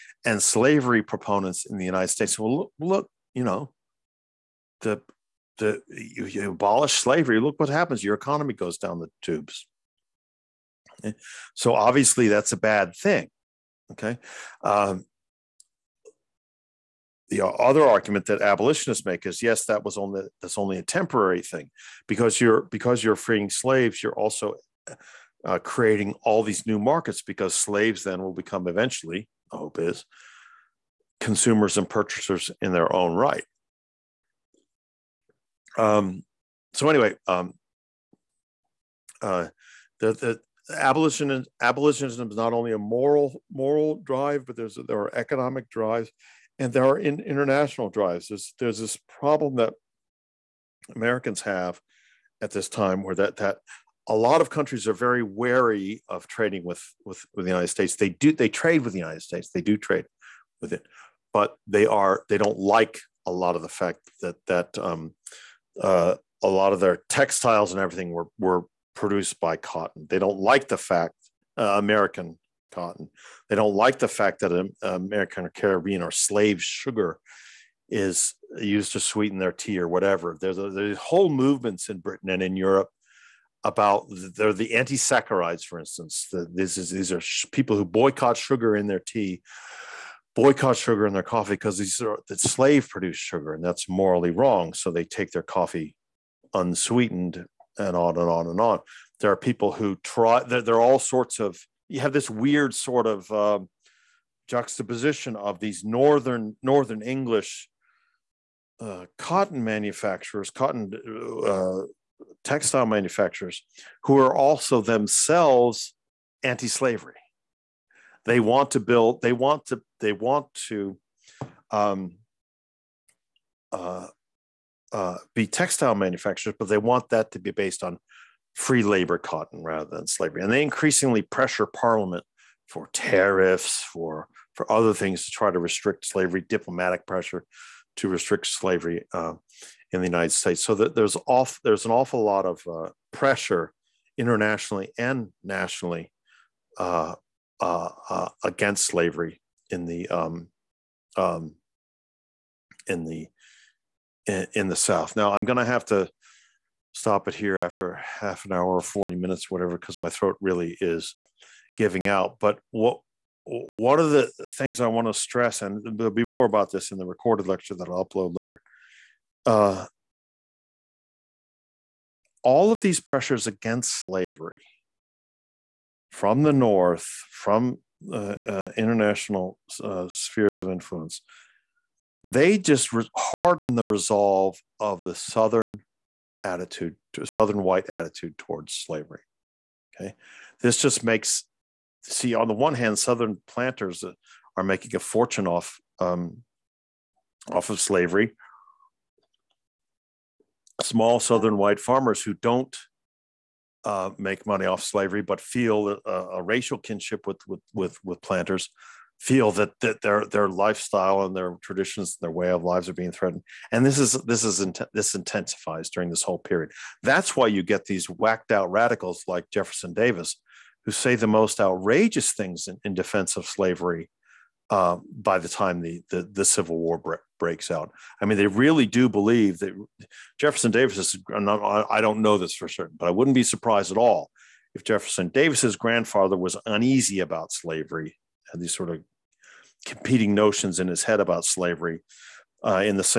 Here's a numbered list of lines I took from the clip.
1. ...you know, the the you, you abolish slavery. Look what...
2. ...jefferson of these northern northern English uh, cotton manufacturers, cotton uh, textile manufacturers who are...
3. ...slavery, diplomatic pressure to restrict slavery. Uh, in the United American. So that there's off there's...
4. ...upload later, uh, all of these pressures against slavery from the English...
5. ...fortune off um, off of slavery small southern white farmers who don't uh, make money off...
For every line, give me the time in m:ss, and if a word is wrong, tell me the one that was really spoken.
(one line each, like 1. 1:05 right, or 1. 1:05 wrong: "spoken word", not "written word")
1. 0:03 right
2. 1:44 wrong: "juxtaposition", not "jefferson"
3. 2:16 wrong: "States", not "American"
4. 2:48 wrong: "North", not "English"
5. 3:14 right.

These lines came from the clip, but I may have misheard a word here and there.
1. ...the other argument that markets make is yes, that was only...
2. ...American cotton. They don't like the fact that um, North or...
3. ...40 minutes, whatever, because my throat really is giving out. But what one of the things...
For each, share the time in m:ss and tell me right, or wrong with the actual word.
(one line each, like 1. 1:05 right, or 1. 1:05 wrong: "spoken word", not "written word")
1. 0:17 wrong: "abolitionists", not "markets"
2. 1:11 wrong: "American", not "North"
3. 2:38 right.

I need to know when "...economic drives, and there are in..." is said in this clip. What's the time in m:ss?
0:45.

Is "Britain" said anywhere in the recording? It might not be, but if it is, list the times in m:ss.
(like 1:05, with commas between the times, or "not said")
1:21.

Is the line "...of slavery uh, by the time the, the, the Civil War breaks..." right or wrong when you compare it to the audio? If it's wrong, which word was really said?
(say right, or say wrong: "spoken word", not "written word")
right.